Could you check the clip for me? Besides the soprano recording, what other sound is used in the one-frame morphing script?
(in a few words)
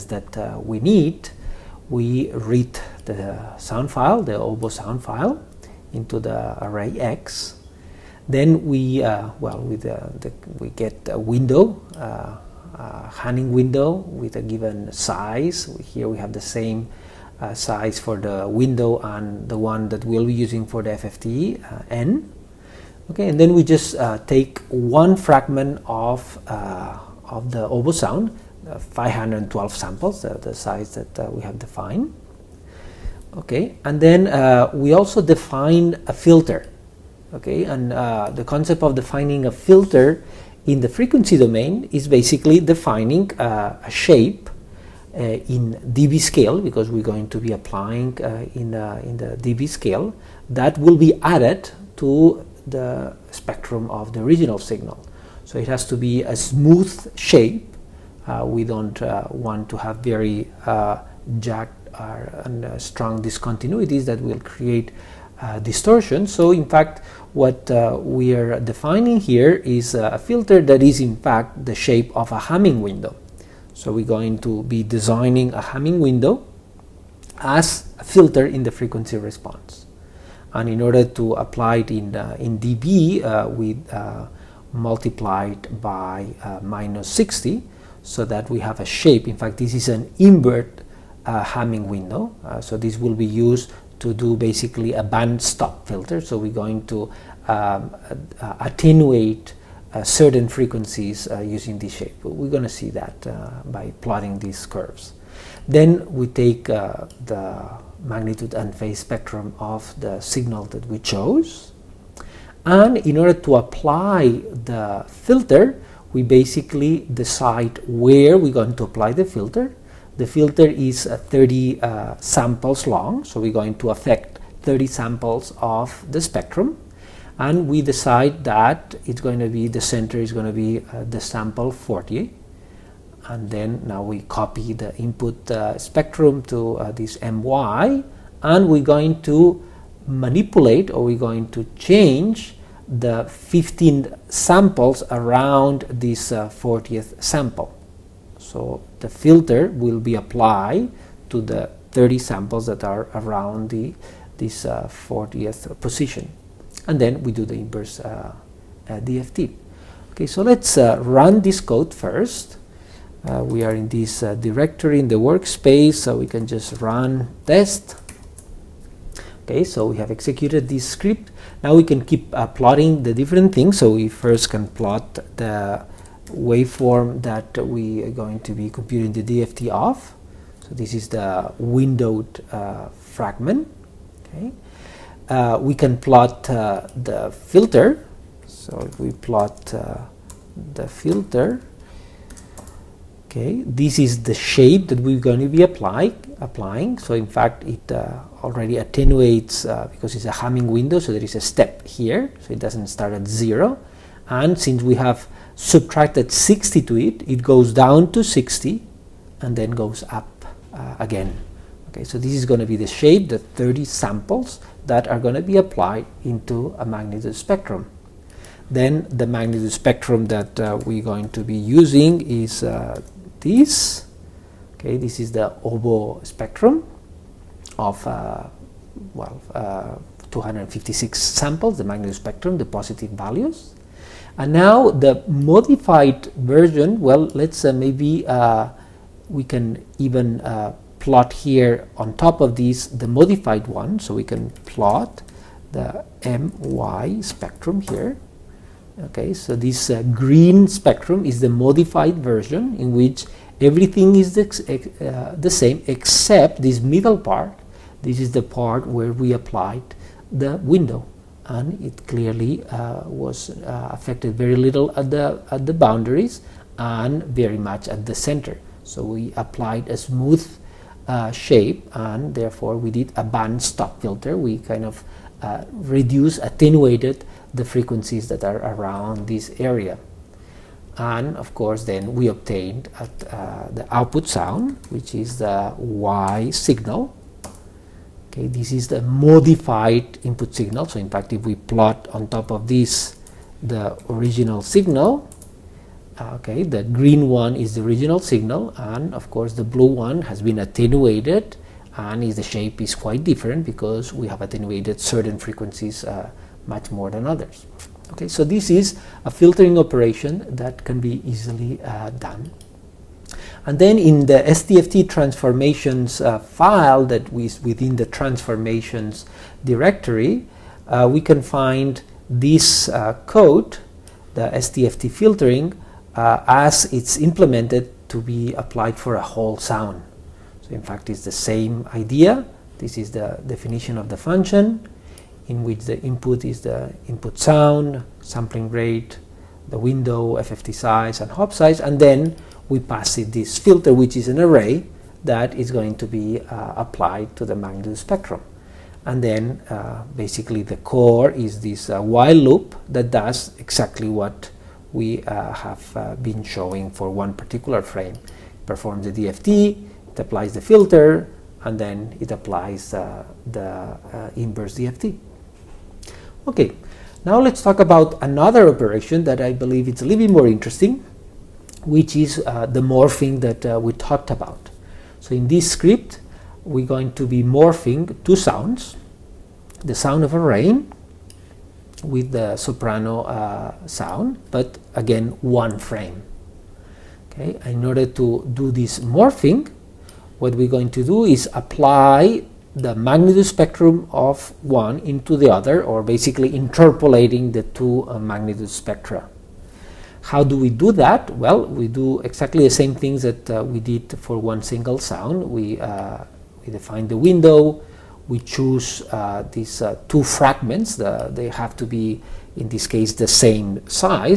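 rain.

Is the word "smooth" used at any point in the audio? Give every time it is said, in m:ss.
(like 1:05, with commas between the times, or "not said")
0:56, 4:29.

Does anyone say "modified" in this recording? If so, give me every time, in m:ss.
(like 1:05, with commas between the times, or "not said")
3:55, 4:03, 4:11, 4:49.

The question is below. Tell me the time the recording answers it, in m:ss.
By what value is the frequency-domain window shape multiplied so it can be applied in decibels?
1:26.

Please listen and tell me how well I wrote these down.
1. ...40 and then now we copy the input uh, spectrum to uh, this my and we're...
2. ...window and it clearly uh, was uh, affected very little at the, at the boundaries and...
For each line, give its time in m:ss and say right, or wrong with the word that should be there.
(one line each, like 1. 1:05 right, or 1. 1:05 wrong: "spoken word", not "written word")
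1. 2:11 right
2. 4:20 right.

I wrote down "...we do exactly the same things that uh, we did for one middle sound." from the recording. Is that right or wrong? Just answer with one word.
wrong.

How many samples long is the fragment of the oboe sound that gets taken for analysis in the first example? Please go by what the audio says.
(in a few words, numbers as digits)
512.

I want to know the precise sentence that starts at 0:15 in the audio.
Here we have the same size for the window and the one that we'll be using for the FFT n.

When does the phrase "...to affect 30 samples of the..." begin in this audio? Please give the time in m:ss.
2:03.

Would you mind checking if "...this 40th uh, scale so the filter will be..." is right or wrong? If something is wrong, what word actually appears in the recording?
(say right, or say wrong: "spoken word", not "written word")
wrong: "sample", not "scale".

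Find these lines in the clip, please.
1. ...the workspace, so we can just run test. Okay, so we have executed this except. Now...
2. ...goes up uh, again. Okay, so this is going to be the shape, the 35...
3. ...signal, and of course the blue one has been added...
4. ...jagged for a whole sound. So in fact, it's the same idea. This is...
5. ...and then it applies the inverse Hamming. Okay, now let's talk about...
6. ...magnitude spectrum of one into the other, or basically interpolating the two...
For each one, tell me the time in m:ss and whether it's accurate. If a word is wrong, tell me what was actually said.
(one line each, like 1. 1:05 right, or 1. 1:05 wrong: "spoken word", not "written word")
1. 2:45 wrong: "script", not "except"
2. 3:29 wrong: "30", not "35"
3. 4:58 wrong: "attenuated", not "added"
4. 5:28 wrong: "applied", not "jagged"
5. 6:01 wrong: "DFT", not "Hamming"
6. 6:32 right.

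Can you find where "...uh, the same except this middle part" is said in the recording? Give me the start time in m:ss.
4:15.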